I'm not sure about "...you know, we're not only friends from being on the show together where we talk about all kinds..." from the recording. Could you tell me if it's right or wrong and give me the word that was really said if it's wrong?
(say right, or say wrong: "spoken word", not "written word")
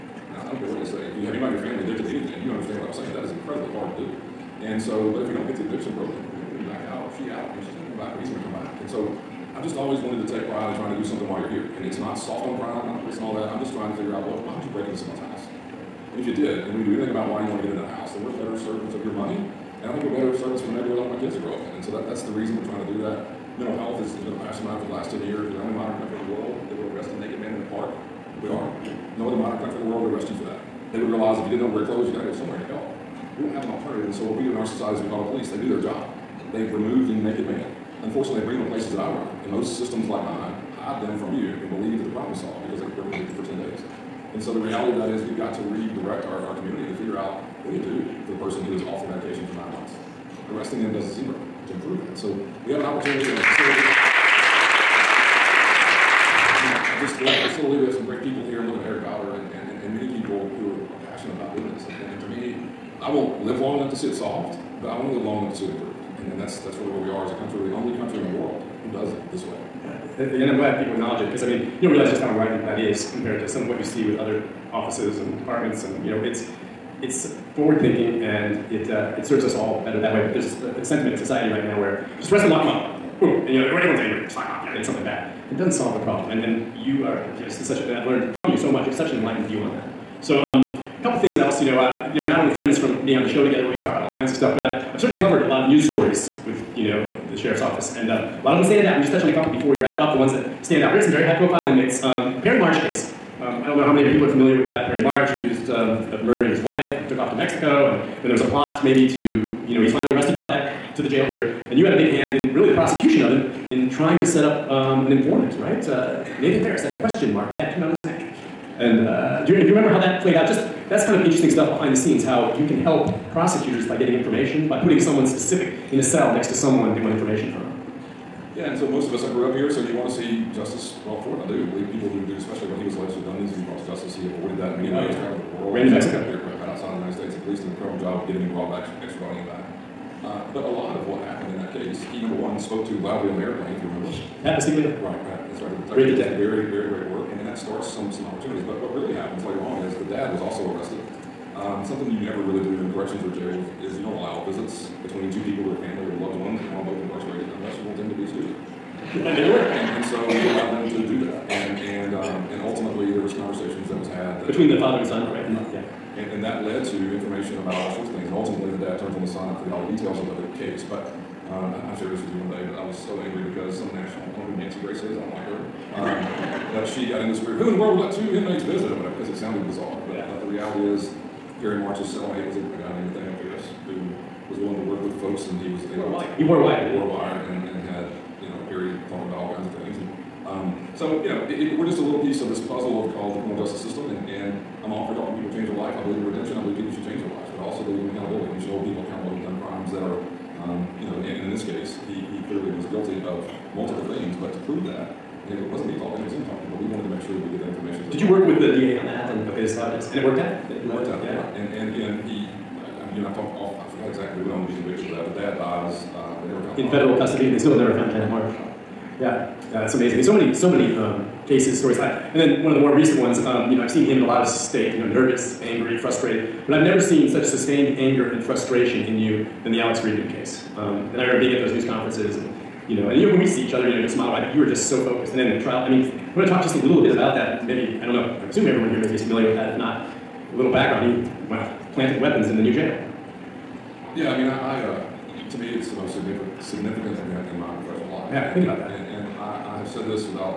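right.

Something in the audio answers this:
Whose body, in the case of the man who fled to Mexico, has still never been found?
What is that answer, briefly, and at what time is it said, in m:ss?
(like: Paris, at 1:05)
Janet March, at 3:38.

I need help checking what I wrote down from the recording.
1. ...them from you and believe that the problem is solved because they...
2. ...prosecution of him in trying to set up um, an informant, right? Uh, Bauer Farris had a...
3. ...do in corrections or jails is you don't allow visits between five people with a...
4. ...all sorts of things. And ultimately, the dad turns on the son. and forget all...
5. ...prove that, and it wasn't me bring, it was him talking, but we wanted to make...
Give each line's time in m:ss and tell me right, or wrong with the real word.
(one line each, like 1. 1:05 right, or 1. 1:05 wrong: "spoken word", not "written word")
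1. 0:41 right
2. 1:52 wrong: "Nathan", not "Bauer"
3. 2:32 wrong: "two", not "five"
4. 2:47 right
5. 3:24 wrong: "talking", not "bring".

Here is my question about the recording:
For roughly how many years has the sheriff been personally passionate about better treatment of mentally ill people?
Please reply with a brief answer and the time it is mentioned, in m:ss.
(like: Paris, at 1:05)
10 years, at 0:24.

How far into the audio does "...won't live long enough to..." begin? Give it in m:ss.
1:03.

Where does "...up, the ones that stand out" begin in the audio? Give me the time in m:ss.
1:39.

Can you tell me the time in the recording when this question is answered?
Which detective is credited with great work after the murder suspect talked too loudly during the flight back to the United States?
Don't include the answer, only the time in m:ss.
2:24.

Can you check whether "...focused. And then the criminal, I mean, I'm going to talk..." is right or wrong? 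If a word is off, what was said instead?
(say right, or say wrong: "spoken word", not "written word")
wrong: "trial", not "criminal".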